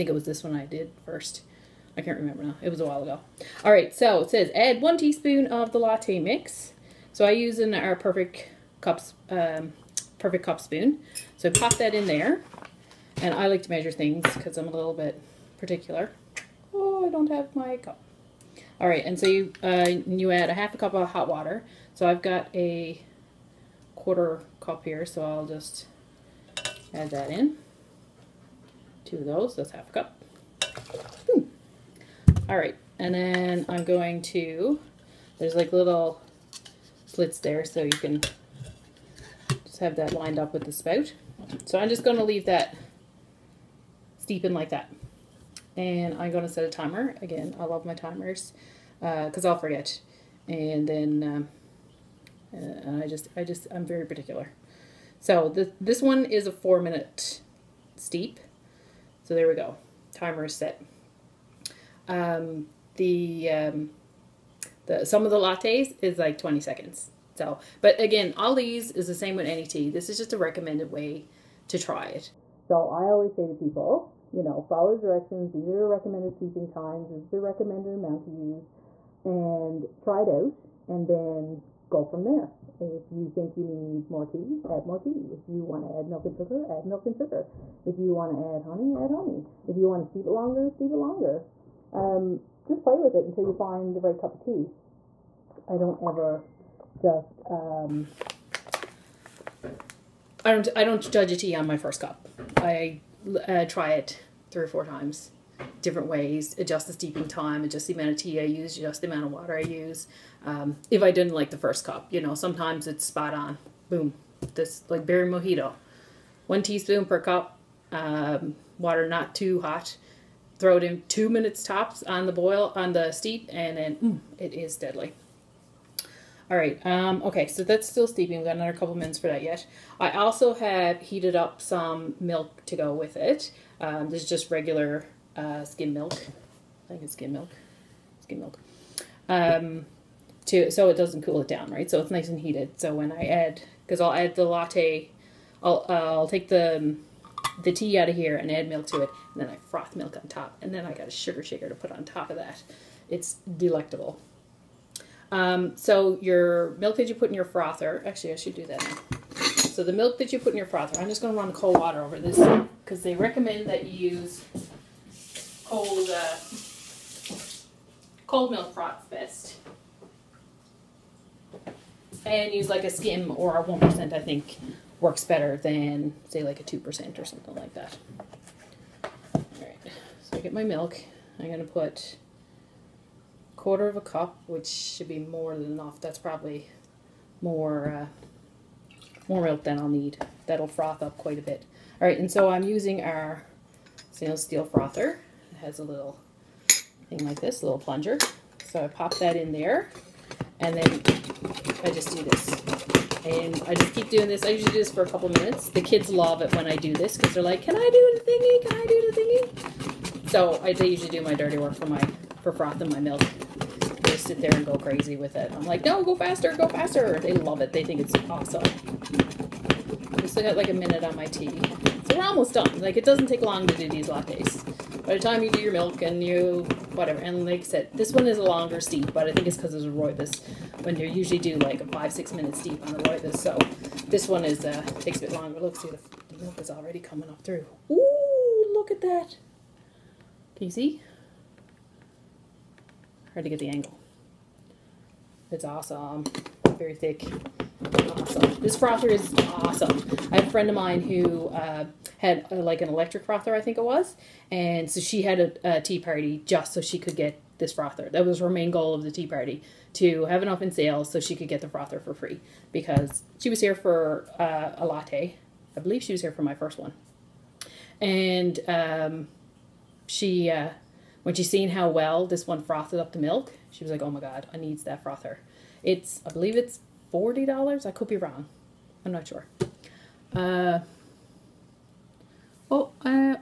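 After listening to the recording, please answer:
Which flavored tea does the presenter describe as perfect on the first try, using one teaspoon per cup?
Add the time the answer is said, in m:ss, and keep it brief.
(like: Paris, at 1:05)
Berry mojito, at 1:55.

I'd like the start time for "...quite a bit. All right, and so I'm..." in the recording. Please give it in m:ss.
3:11.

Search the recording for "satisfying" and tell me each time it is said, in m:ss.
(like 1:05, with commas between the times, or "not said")
not said.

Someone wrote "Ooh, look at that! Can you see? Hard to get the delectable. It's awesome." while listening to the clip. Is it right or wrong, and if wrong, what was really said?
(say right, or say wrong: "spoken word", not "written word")
wrong: "angle", not "delectable".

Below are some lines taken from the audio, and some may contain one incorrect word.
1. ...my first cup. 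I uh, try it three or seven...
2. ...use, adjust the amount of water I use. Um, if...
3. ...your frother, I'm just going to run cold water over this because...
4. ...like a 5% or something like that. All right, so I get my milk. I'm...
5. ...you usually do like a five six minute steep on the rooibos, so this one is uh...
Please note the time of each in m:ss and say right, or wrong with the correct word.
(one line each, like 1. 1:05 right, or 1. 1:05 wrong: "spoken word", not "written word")
1. 1:41 wrong: "four", not "seven"
2. 1:48 right
3. 2:40 right
4. 2:56 wrong: "2", not "5"
5. 3:50 right.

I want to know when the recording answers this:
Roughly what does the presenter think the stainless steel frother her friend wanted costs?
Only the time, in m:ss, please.
4:37.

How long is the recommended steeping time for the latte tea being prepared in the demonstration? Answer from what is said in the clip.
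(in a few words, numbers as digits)
4 minutes.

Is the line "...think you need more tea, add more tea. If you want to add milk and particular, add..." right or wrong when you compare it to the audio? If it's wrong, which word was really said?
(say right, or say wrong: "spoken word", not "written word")
wrong: "sugar", not "particular".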